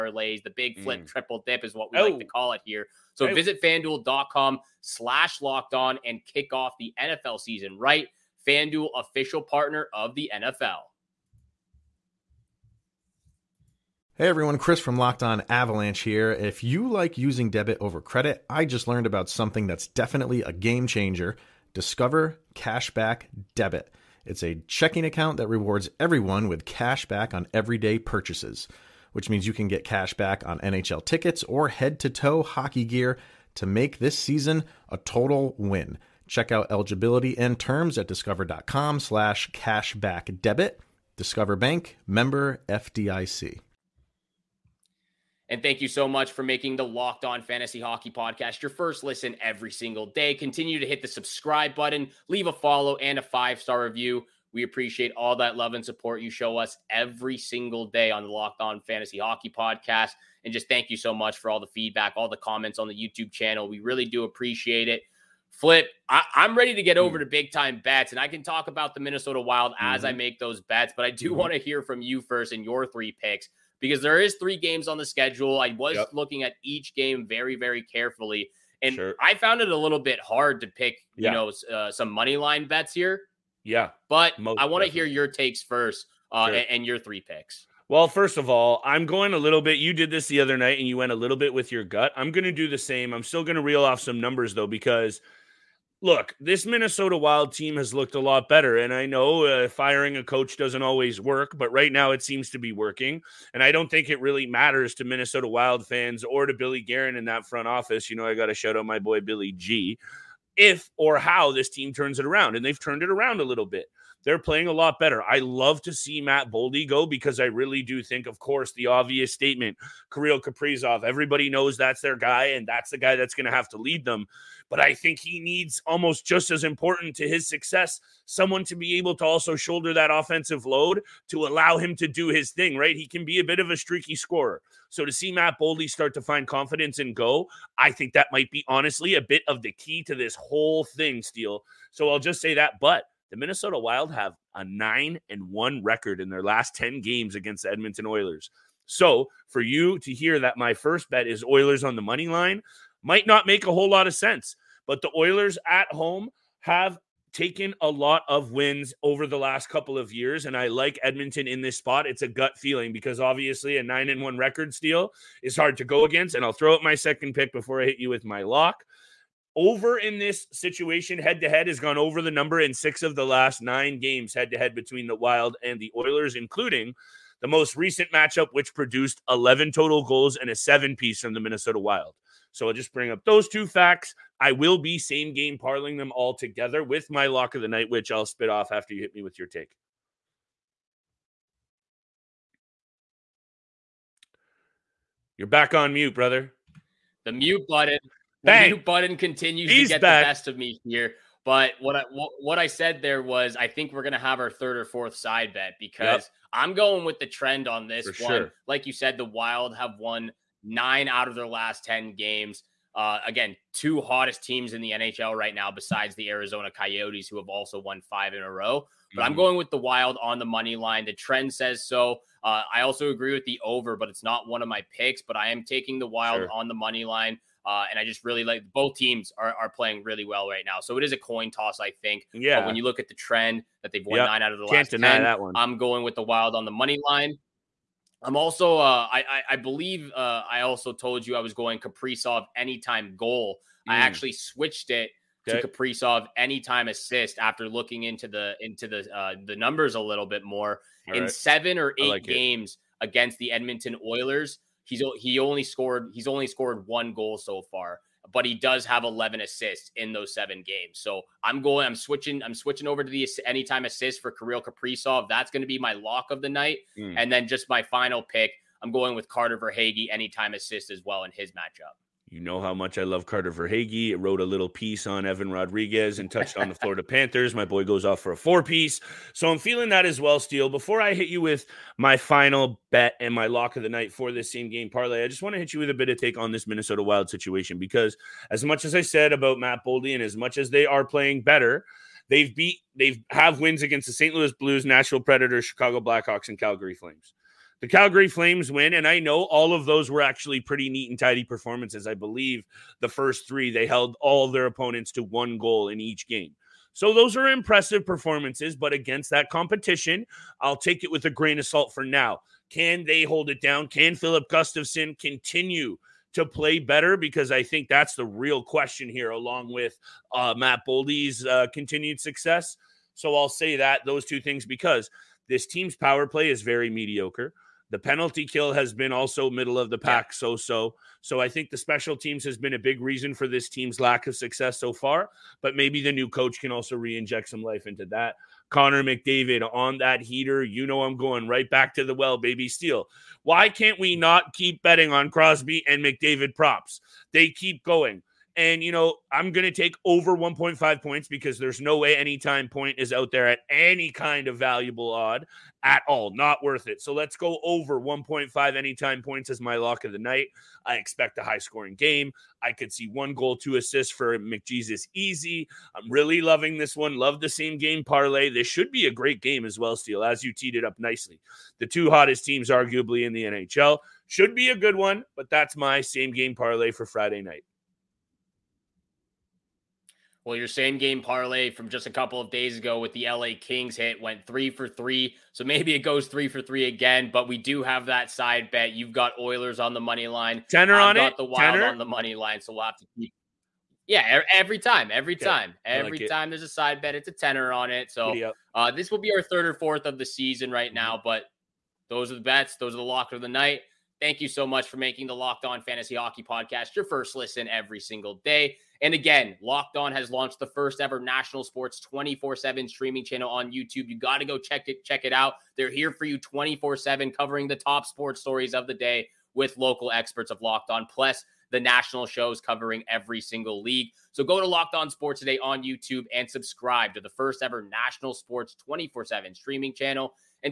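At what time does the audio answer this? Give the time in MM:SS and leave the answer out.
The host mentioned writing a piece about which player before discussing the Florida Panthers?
04:35.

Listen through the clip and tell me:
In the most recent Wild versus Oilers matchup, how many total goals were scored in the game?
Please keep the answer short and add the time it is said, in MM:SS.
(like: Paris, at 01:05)
11, at 02:59.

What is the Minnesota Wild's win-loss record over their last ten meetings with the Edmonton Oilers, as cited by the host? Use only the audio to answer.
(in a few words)
9 and 1.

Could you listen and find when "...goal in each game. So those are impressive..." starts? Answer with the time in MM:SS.
05:05.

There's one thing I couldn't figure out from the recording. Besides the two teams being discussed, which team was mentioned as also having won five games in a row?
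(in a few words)
Arizona Coyotes.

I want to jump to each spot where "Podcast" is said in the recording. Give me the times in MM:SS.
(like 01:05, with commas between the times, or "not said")
00:48, 00:59, 06:46.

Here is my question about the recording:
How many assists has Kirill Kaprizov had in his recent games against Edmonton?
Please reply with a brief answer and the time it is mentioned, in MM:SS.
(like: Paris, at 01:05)
11, at 04:19.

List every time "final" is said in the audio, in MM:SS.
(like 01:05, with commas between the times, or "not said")
04:27, 04:42.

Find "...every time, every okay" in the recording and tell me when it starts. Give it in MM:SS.
06:34.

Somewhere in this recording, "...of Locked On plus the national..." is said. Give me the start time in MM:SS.
07:00.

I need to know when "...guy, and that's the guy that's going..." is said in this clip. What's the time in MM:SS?
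02:02.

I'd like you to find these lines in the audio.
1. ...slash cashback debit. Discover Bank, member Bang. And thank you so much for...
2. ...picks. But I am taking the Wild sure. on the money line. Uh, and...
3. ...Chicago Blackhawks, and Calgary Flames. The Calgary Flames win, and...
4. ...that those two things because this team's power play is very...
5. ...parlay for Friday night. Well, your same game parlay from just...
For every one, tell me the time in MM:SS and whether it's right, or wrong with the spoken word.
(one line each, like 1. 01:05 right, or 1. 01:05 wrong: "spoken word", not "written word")
1. 00:38 wrong: "FDIC", not "Bang"
2. 03:44 right
3. 04:55 right
4. 05:23 right
5. 06:16 right.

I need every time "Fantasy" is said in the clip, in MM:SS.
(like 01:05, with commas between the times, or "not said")
00:47, 00:58, 06:45.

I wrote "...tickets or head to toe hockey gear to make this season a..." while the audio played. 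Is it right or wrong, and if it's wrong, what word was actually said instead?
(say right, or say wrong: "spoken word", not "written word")
right.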